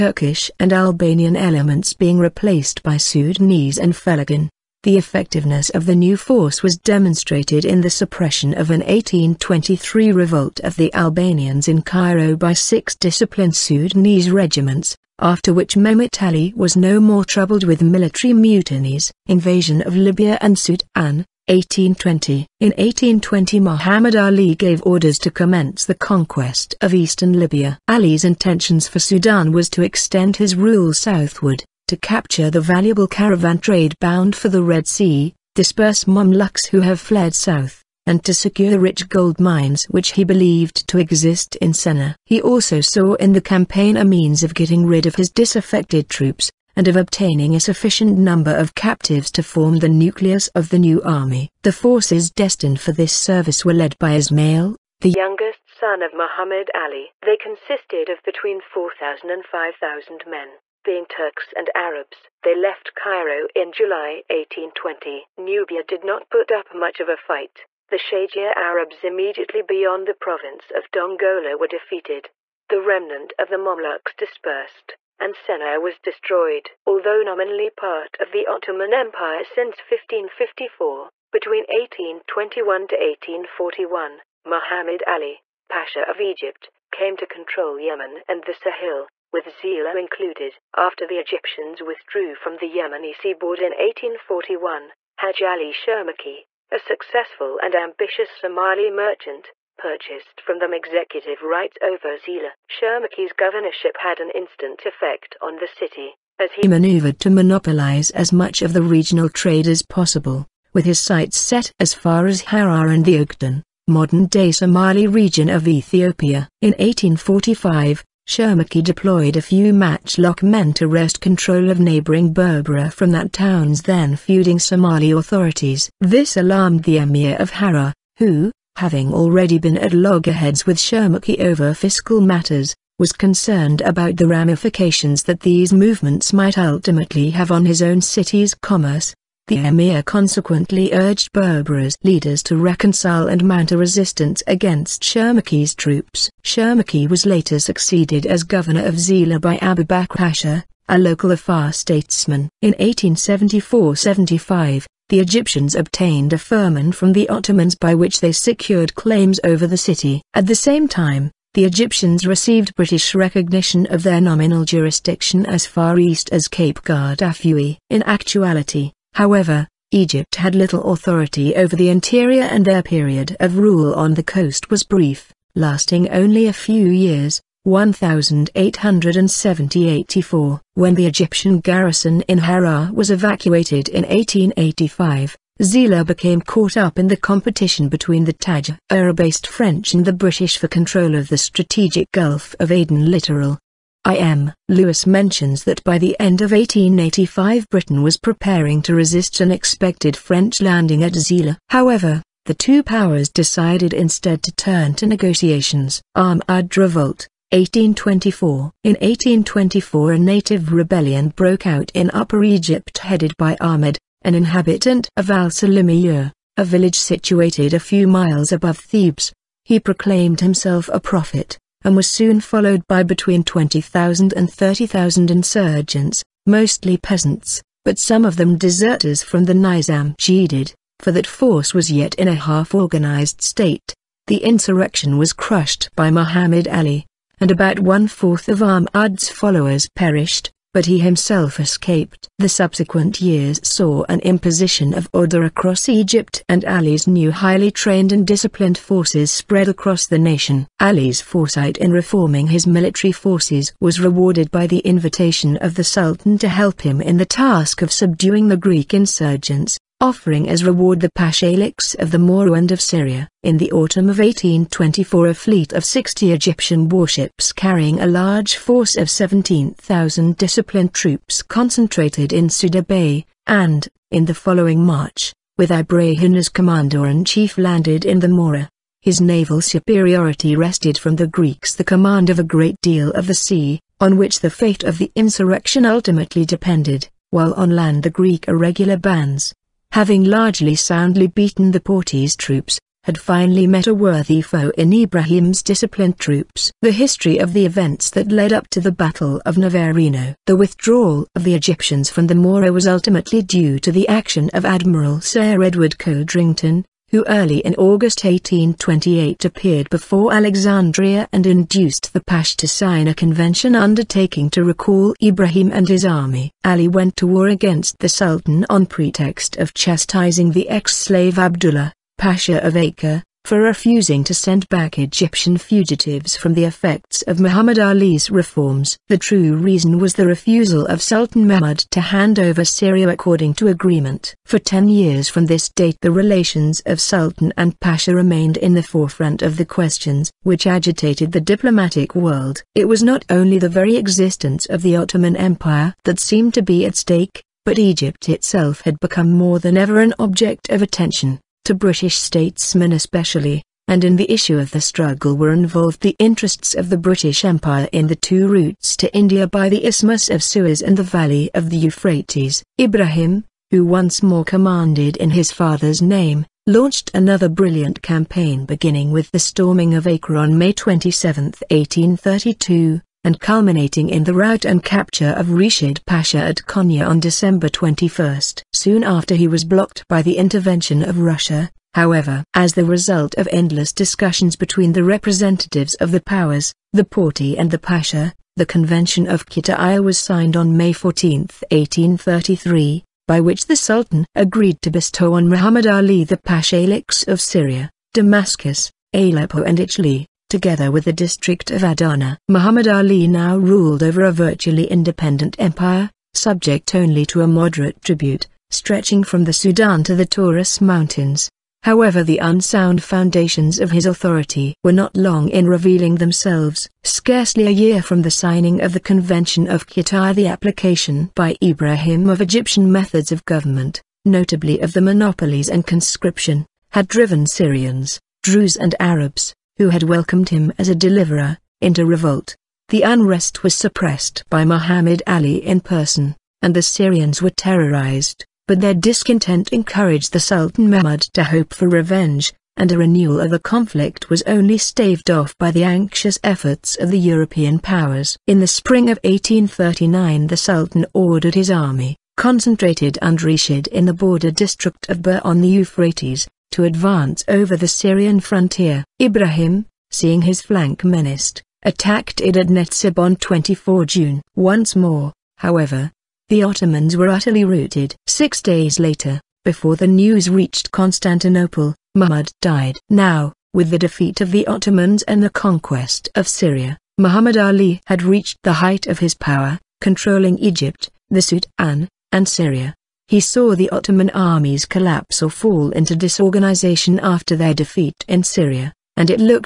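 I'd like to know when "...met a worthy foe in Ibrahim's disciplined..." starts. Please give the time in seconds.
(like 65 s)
293 s.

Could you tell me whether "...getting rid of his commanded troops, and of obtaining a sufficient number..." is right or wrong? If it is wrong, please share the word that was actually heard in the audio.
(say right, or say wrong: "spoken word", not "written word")
wrong: "disaffected", not "commanded".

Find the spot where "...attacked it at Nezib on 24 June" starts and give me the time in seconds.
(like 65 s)
461 s.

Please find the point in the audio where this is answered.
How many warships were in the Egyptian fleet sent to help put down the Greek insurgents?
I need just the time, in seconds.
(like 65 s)
265 s.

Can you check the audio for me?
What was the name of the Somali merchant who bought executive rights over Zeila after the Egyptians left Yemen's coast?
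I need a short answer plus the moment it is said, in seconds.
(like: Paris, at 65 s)
Haj Ali Sharmarke, at 95 s.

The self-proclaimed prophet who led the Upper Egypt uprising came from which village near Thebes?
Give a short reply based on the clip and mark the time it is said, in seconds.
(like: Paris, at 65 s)
al Salimiyeh, at 215 s.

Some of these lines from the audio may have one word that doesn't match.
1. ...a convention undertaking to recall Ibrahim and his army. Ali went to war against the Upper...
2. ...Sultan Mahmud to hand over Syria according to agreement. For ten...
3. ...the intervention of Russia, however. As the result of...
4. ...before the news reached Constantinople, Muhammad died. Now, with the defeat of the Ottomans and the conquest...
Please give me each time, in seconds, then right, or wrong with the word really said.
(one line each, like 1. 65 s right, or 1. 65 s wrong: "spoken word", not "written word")
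1. 313 s wrong: "Sultan", not "Upper"
2. 331 s right
3. 380 s right
4. 469 s right.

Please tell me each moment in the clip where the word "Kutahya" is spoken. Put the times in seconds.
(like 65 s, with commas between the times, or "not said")
389 s, 419 s.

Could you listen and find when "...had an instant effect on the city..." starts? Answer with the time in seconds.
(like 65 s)
103 s.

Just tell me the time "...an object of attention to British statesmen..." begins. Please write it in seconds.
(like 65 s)
350 s.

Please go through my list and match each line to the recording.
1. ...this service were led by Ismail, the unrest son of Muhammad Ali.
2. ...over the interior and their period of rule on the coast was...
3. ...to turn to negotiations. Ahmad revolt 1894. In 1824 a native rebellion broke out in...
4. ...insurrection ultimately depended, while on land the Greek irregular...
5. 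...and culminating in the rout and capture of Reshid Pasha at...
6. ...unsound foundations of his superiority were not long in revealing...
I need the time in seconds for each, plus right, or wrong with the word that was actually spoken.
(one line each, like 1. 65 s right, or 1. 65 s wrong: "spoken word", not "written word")
1. 52 s wrong: "youngest", not "unrest"
2. 171 s right
3. 204 s wrong: "1824", not "1894"
4. 285 s right
5. 373 s right
6. 412 s wrong: "authority", not "superiority".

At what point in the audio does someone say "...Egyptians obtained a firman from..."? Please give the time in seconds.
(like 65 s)
155 s.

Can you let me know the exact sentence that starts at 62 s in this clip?
They left Cairo in July 1820.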